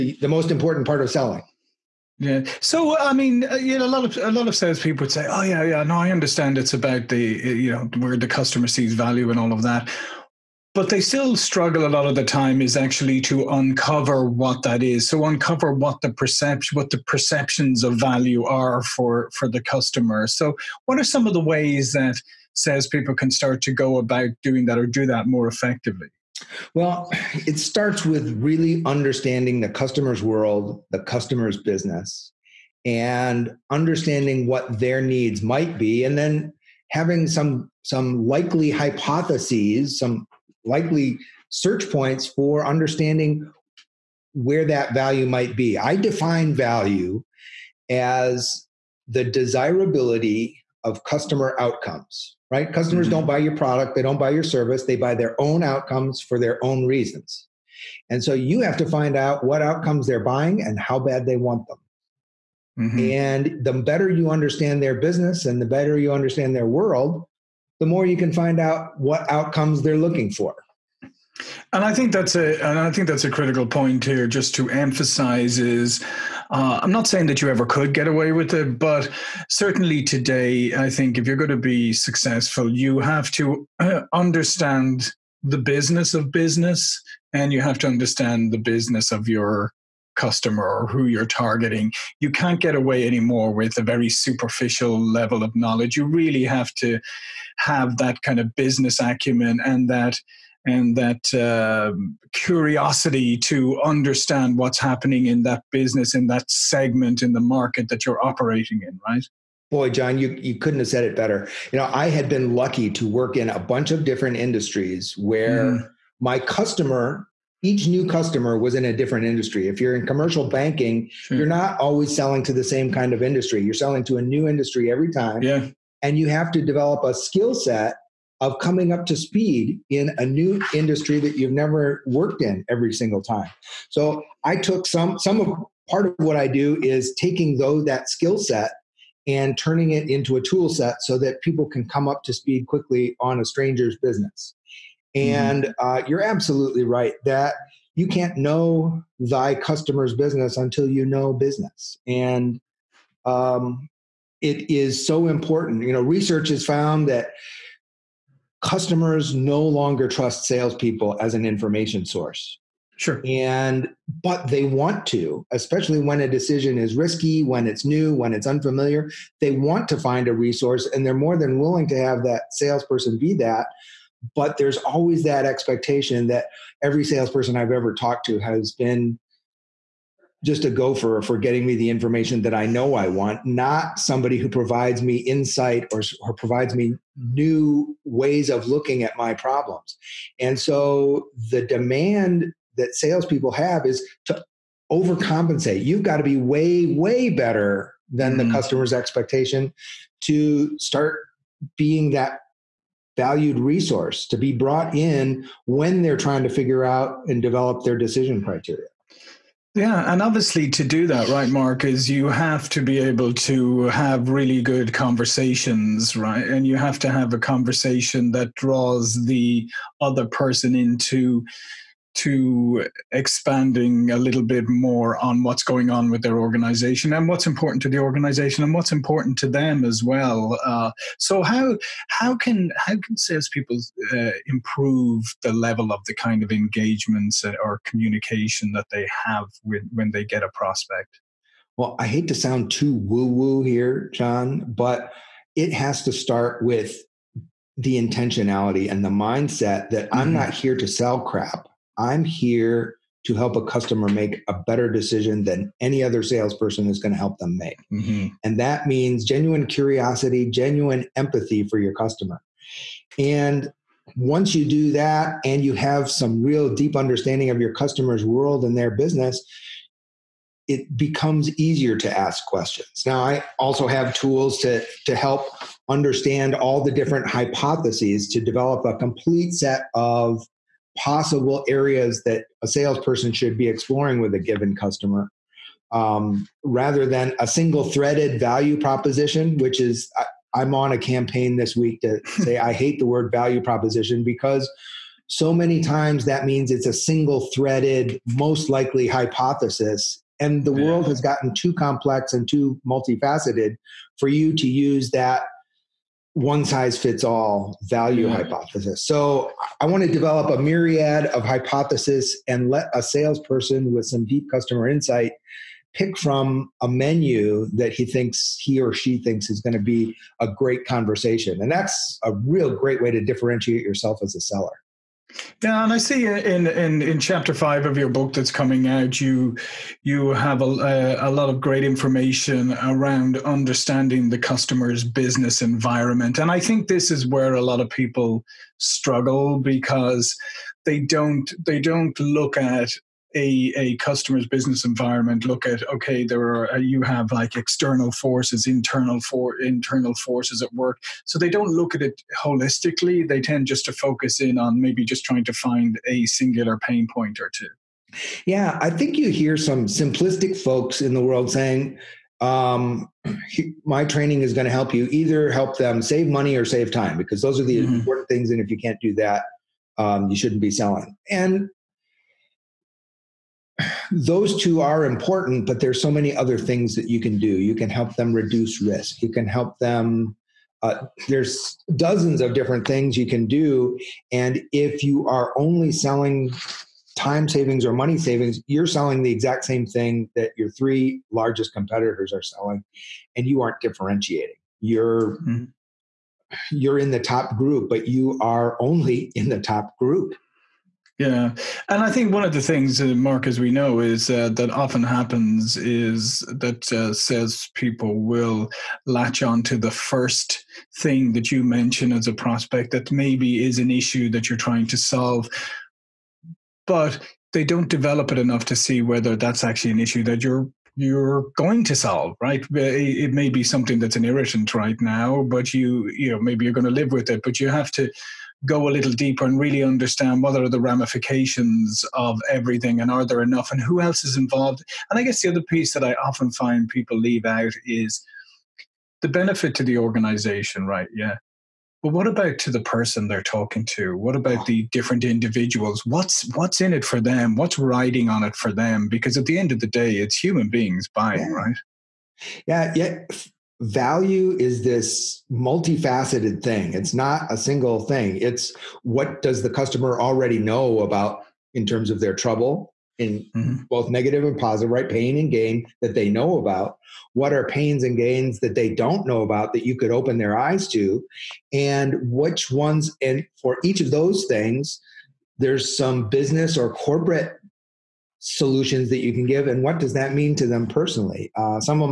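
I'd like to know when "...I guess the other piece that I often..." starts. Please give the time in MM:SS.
07:15.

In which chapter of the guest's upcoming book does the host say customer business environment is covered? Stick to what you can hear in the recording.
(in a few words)
chapter 5.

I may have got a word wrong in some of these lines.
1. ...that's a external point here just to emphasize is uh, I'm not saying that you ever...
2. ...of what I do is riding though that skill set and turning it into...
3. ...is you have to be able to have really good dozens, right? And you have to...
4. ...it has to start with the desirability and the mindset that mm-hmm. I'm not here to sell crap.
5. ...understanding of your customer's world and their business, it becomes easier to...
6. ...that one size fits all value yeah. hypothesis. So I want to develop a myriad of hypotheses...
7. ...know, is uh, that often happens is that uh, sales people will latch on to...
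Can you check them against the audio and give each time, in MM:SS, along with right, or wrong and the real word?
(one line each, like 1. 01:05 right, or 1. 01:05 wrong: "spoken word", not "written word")
1. 01:13 wrong: "critical", not "external"
2. 02:16 wrong: "taking", not "riding"
3. 03:31 wrong: "conversations", not "dozens"
4. 04:05 wrong: "intentionality", not "desirability"
5. 04:26 right
6. 05:05 right
7. 06:43 right.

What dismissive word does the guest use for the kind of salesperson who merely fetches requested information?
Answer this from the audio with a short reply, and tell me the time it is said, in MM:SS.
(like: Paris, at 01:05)
gopher, at 03:00.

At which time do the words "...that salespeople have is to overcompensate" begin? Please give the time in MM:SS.
03:12.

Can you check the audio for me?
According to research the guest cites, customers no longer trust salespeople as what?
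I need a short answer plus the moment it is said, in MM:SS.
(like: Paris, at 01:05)
an information source, at 02:41.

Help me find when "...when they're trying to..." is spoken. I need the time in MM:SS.
03:25.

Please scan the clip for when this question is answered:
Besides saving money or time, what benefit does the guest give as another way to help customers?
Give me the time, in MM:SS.
06:18.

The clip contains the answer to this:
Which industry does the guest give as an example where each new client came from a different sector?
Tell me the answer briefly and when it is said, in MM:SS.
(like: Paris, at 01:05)
commercial banking, at 02:00.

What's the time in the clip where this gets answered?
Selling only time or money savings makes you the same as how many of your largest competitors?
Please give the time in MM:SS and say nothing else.
06:30.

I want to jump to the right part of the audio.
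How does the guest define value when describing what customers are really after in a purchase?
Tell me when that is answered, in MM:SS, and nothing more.
00:49.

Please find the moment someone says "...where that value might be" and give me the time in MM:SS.
00:44.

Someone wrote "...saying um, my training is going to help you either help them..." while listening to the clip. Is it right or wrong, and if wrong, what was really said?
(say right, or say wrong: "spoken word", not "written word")
right.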